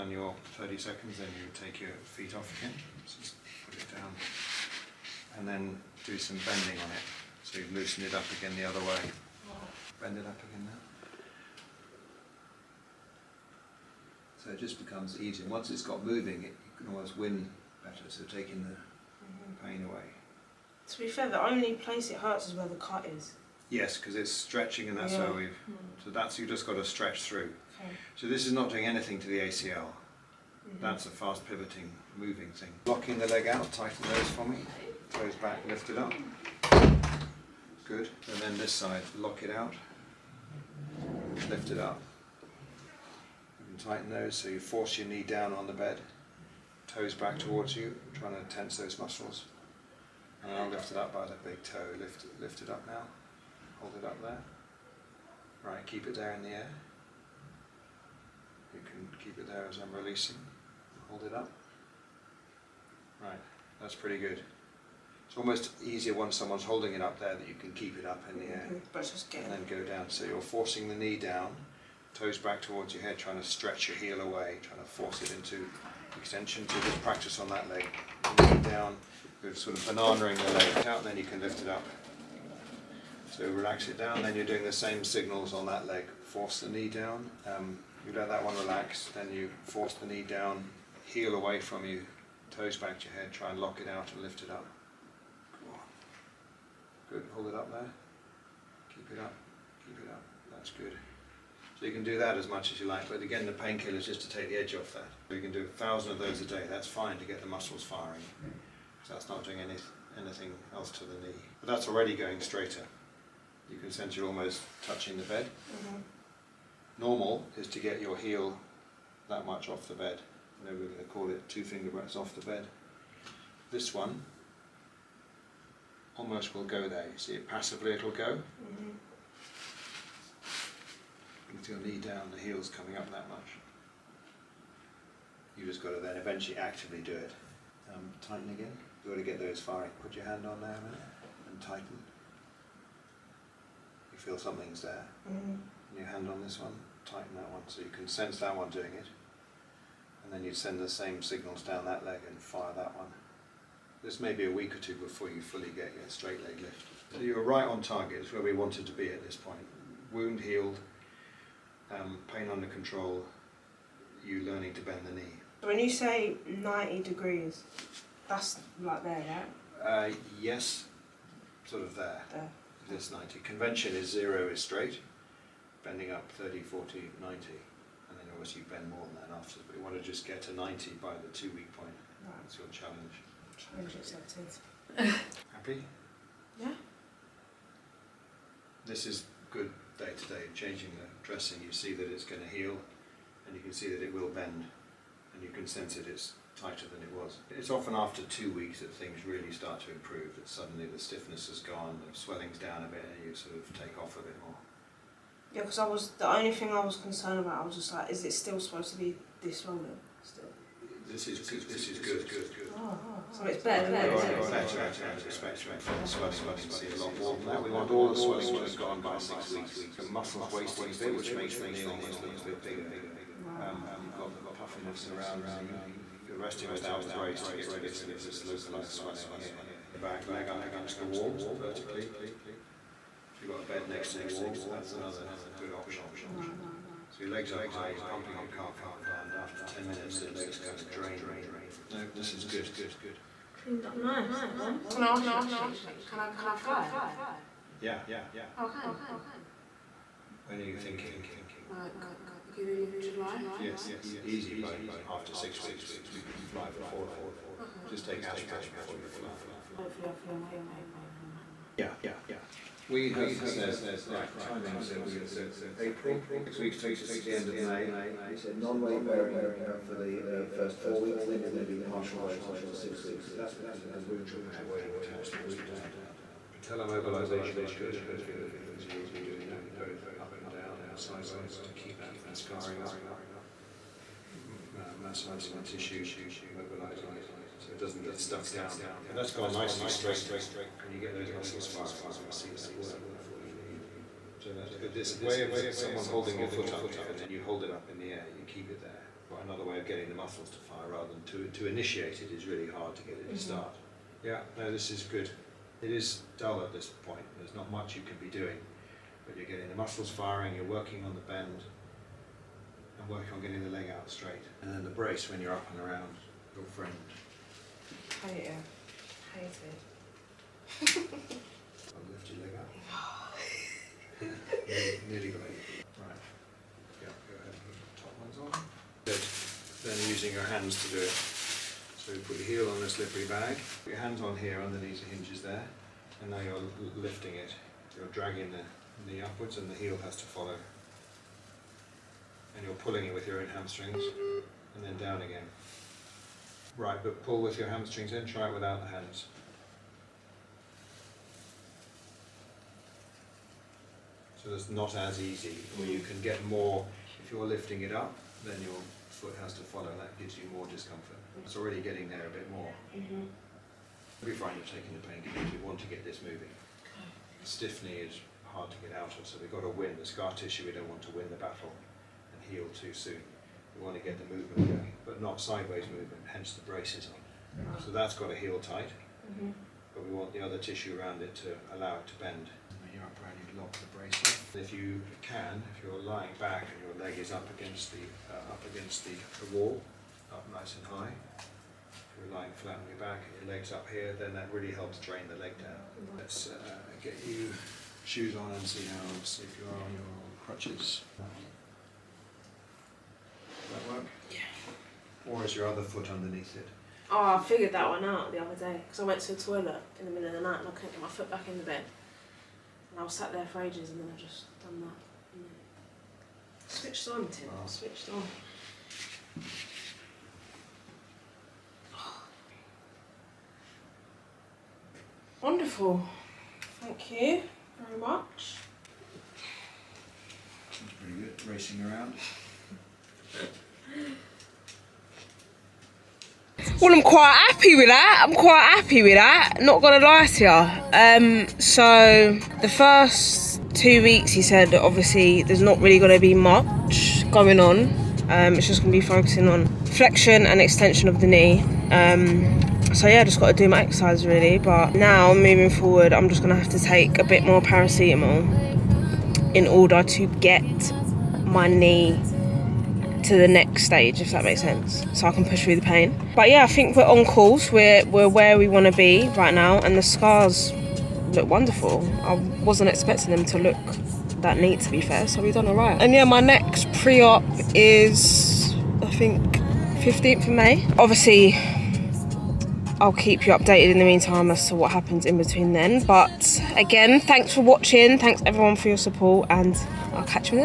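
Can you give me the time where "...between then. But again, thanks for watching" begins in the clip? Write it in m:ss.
8:05.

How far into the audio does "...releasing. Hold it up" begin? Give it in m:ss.
0:59.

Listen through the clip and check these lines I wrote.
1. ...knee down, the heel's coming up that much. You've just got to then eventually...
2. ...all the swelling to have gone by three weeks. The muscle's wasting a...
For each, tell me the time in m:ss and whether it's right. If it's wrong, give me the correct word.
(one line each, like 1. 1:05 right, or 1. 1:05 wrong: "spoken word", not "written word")
1. 2:11 right
2. 3:37 wrong: "six", not "three".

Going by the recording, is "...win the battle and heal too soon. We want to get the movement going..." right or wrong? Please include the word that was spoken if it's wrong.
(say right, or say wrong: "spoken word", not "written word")
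right.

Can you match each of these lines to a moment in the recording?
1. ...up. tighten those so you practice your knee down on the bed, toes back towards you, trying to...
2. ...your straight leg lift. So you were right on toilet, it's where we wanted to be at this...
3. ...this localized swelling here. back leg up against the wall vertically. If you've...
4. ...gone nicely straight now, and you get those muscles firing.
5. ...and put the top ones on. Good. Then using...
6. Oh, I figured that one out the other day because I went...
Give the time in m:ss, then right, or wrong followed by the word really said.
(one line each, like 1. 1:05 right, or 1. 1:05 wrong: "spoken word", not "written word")
1. 0:41 wrong: "force", not "practice"
2. 2:35 wrong: "target", not "toilet"
3. 3:48 right
4. 4:49 right
5. 5:27 right
6. 6:47 right.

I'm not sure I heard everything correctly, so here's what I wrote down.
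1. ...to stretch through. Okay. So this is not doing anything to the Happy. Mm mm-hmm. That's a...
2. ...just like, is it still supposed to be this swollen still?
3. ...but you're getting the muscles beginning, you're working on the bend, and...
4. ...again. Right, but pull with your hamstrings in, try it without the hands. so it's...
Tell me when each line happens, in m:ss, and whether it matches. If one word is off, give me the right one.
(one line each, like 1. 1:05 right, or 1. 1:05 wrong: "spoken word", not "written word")
1. 0:26 wrong: "ACL", not "Happy"
2. 3:27 right
3. 5:09 wrong: "firing", not "beginning"
4. 5:45 right.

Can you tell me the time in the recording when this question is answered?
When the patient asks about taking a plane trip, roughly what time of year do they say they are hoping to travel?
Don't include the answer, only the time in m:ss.
4:12.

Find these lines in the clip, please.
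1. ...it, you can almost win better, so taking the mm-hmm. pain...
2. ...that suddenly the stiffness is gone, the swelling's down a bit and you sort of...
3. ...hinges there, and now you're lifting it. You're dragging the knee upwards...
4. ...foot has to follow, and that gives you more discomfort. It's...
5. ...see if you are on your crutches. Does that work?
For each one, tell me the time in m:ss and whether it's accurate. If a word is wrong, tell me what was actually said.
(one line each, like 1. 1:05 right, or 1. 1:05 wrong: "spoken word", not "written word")
1. 0:16 right
2. 3:20 right
3. 5:35 right
4. 5:59 right
5. 6:39 right.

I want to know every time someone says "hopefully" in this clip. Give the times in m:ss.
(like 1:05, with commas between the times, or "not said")
4:19, 4:38.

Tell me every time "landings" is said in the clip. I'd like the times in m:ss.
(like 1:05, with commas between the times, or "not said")
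not said.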